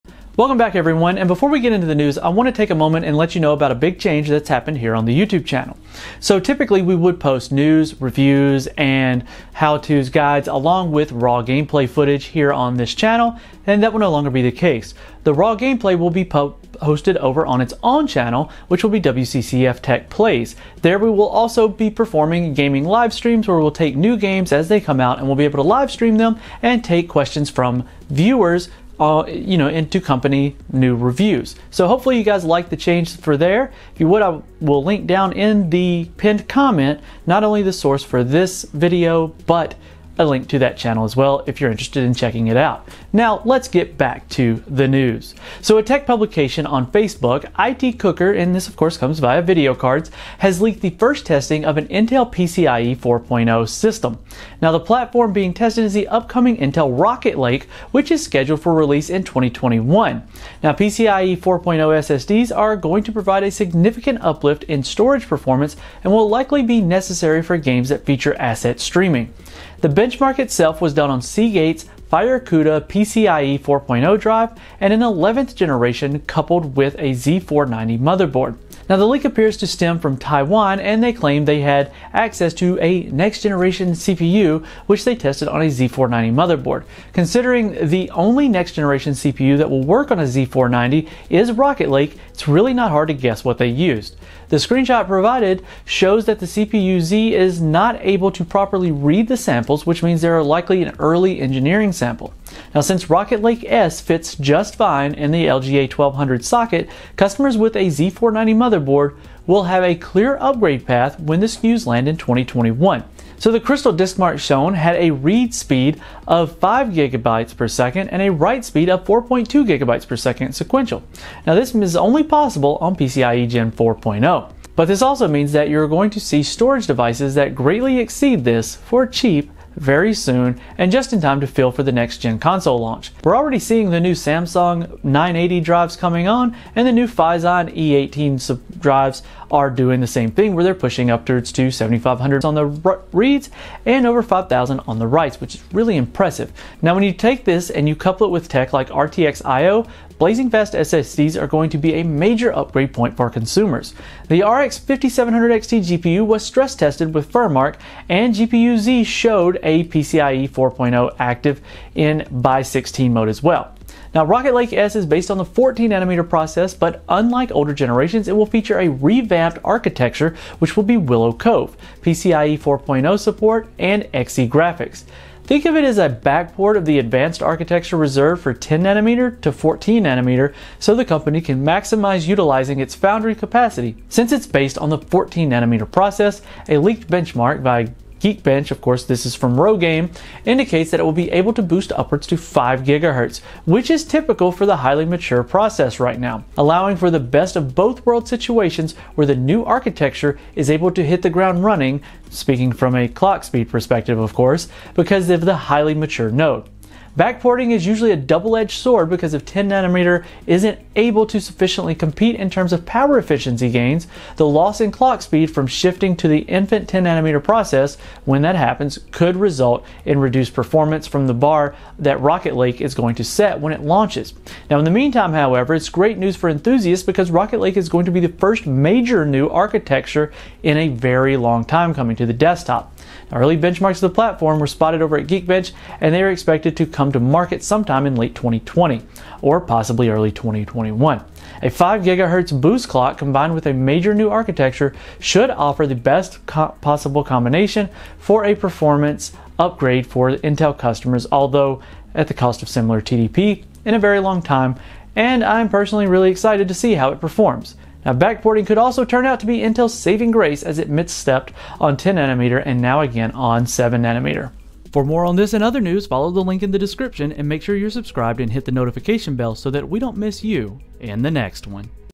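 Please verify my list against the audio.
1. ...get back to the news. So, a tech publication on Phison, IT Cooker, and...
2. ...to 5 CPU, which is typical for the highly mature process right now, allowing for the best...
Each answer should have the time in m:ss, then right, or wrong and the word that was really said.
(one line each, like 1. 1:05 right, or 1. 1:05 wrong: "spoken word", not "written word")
1. 0:43 wrong: "Facebook", not "Phison"
2. 3:12 wrong: "GHz", not "CPU".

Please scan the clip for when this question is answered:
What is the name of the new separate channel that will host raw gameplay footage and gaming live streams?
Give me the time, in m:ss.
0:18.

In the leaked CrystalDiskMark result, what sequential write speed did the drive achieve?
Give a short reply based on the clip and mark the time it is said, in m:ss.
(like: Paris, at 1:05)
4.2 gigabytes per second, at 1:59.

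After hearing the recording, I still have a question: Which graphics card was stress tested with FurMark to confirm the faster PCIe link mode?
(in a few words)
RX 5700 XT.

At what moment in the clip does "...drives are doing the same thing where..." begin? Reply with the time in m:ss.
2:18.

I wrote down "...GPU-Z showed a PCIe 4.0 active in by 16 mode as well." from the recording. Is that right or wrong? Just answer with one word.
right.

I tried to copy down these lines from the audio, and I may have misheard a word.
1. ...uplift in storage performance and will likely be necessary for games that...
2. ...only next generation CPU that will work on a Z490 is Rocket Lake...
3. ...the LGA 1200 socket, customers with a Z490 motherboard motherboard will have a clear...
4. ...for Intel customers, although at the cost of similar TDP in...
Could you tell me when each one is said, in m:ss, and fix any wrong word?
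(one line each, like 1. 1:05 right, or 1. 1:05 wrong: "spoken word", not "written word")
1. 1:04 right
2. 1:28 right
3. 1:45 right
4. 4:10 right.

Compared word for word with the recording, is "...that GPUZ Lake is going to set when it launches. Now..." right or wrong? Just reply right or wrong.
wrong.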